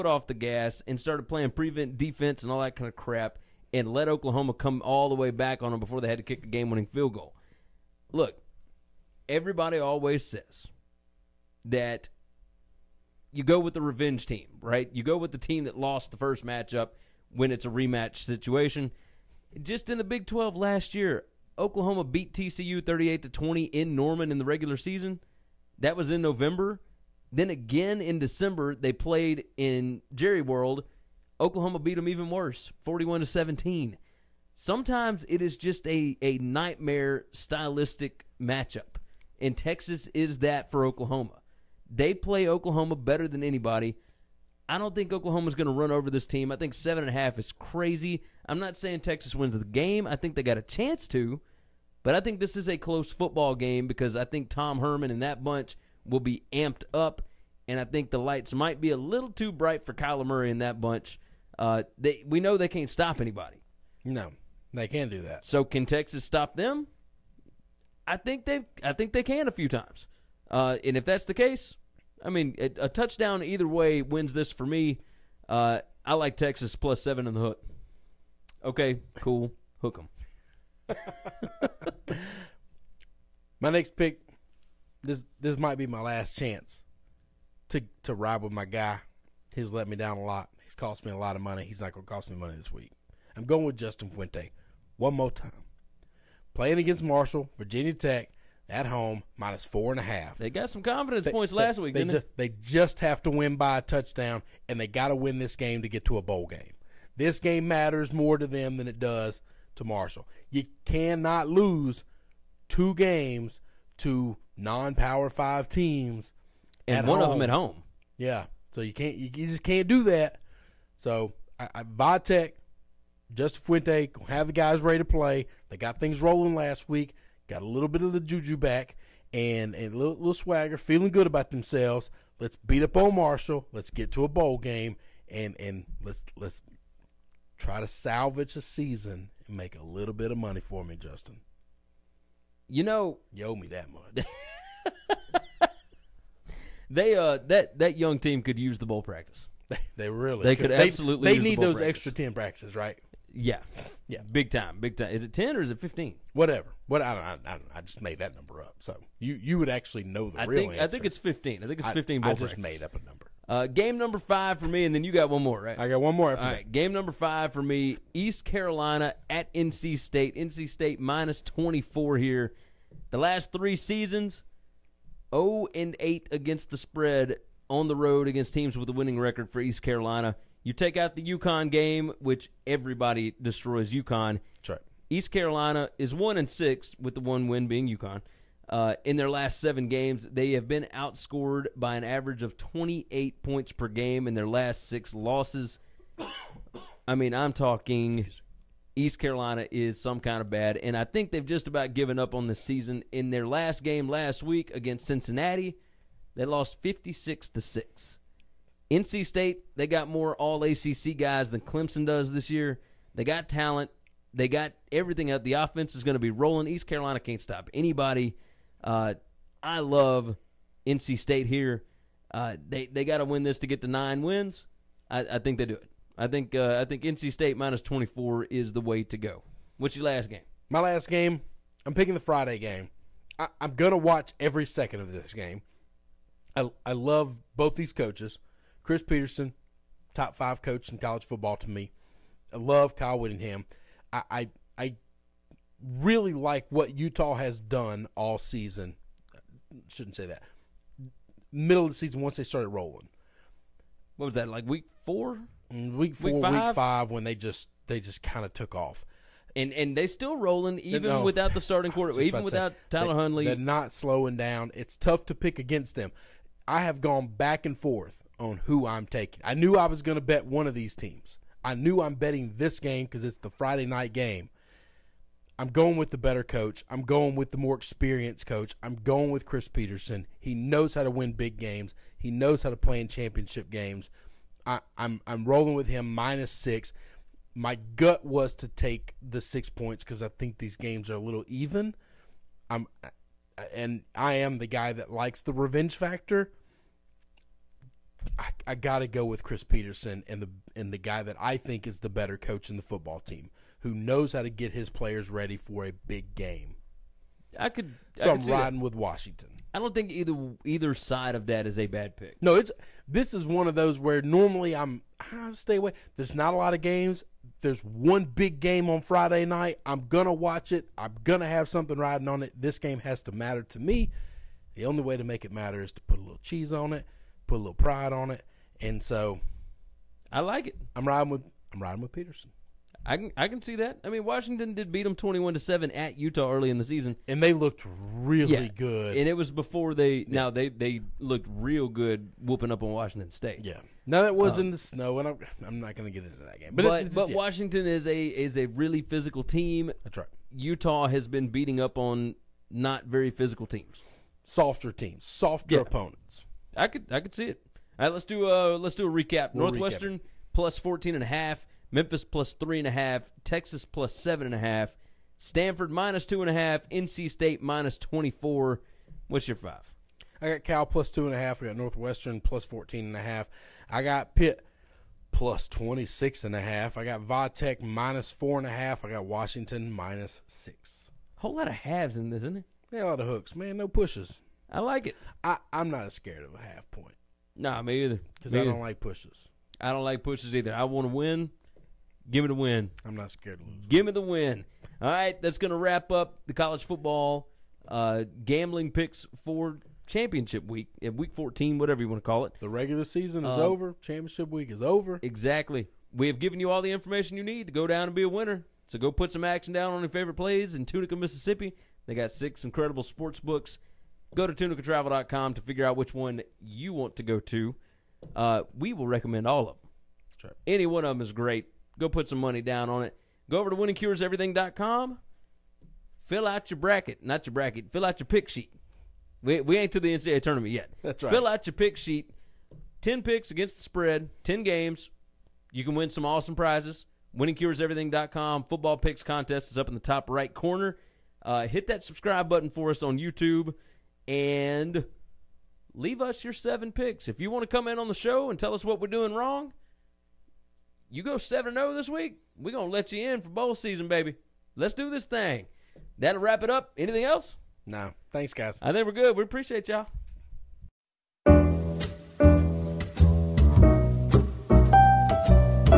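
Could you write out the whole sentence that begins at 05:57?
All right, let's do a let's do a recap.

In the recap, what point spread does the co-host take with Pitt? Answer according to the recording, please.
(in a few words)
plus 26.5.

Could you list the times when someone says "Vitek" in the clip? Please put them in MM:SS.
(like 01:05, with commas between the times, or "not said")
02:01, 06:17.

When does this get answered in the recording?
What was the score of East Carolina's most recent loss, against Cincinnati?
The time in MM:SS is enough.
03:26.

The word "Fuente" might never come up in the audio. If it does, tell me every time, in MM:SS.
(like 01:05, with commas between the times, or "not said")
01:34, 02:03.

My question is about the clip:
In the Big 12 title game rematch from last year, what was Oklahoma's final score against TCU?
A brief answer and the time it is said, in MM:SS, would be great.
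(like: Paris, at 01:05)
41 to 17, at 00:32.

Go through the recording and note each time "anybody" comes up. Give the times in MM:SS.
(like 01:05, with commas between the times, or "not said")
00:43, 01:03, 03:37.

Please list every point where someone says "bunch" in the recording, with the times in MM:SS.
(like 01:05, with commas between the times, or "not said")
00:55, 01:00.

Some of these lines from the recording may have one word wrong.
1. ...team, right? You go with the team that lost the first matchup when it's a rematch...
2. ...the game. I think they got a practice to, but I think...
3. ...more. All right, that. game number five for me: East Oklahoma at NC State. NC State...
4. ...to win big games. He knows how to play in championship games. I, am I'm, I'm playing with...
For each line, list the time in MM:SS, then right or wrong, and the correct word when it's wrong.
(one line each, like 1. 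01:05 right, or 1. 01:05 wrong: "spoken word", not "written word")
1. 00:14 right
2. 00:49 wrong: "chance", not "practice"
3. 02:46 wrong: "Carolina", not "Oklahoma"
4. 04:41 wrong: "rolling", not "playing".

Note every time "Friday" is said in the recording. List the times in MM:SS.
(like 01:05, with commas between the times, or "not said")
03:52, 04:33, 05:19.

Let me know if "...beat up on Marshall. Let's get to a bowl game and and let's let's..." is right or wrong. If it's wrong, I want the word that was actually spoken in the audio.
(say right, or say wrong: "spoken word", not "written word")
right.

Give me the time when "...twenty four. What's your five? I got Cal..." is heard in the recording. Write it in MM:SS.
06:07.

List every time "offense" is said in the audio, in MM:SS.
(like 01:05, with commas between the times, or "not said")
03:35.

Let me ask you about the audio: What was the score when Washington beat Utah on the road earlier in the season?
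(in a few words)
21 to 7.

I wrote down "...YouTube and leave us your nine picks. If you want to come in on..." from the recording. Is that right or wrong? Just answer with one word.
wrong.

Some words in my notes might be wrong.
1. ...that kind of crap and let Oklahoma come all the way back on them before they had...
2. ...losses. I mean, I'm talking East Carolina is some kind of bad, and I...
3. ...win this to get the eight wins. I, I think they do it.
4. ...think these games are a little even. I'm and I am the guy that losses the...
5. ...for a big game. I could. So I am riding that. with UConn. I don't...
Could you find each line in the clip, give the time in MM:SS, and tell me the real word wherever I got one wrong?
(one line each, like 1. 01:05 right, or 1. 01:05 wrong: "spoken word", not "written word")
1. 00:02 right
2. 03:15 right
3. 03:43 wrong: "nine", not "eight"
4. 04:50 wrong: "likes", not "losses"
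5. 05:05 wrong: "Washington", not "UConn".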